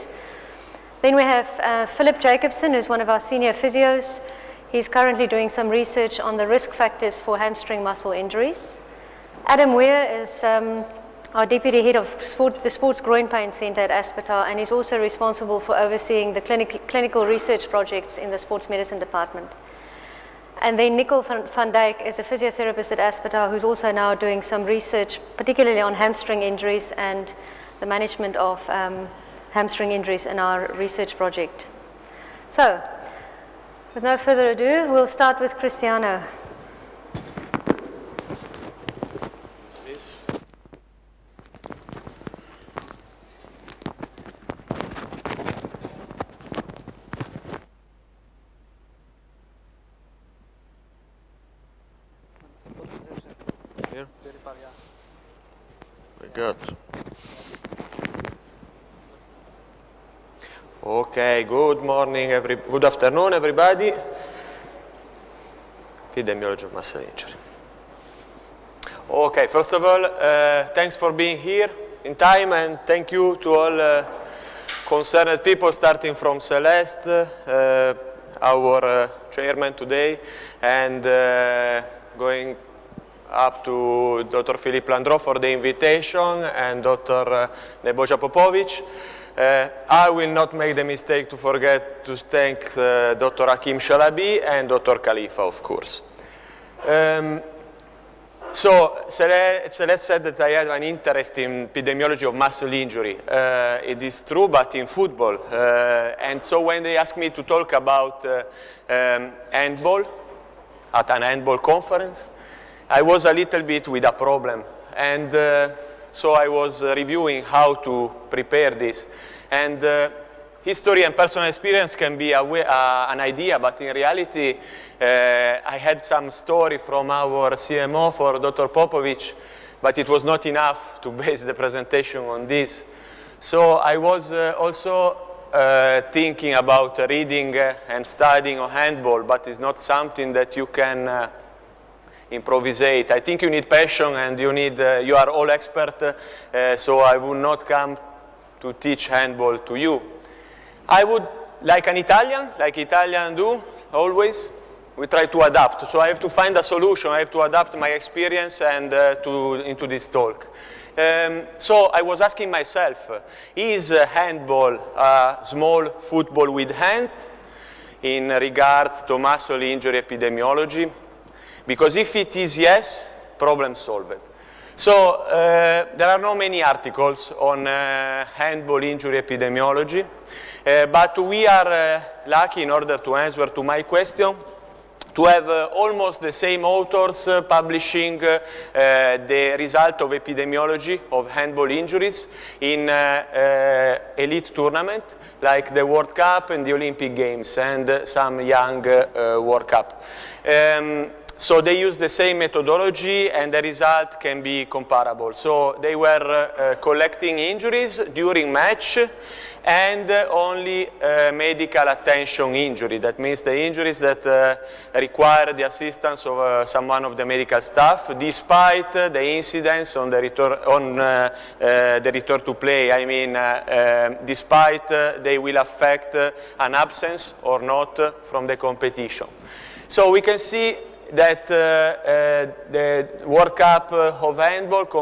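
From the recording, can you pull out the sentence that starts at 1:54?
And uh, so I was uh, reviewing how to prepare this.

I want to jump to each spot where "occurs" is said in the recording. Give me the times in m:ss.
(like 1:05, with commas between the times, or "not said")
not said.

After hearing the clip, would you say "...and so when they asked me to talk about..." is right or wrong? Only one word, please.
right.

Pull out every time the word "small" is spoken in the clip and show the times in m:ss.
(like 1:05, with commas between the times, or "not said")
2:45.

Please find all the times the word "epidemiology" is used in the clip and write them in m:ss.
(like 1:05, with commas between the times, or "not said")
1:06, 1:41, 2:50, 2:59, 3:10.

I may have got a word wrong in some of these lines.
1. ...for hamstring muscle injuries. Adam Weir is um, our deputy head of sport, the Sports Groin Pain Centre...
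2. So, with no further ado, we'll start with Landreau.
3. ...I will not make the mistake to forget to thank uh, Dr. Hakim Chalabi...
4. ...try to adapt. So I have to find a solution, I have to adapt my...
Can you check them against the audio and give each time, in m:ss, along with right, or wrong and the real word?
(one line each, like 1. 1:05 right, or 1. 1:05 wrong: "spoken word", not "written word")
1. 0:07 right
2. 0:32 wrong: "Cristiano", not "Landreau"
3. 1:29 right
4. 2:35 right.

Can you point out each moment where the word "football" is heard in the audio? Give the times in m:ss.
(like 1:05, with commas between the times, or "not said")
1:44, 2:45.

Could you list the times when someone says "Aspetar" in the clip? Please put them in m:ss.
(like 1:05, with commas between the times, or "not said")
0:13, 0:22.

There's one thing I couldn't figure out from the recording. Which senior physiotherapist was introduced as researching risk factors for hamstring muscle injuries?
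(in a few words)
Philip Jacobson.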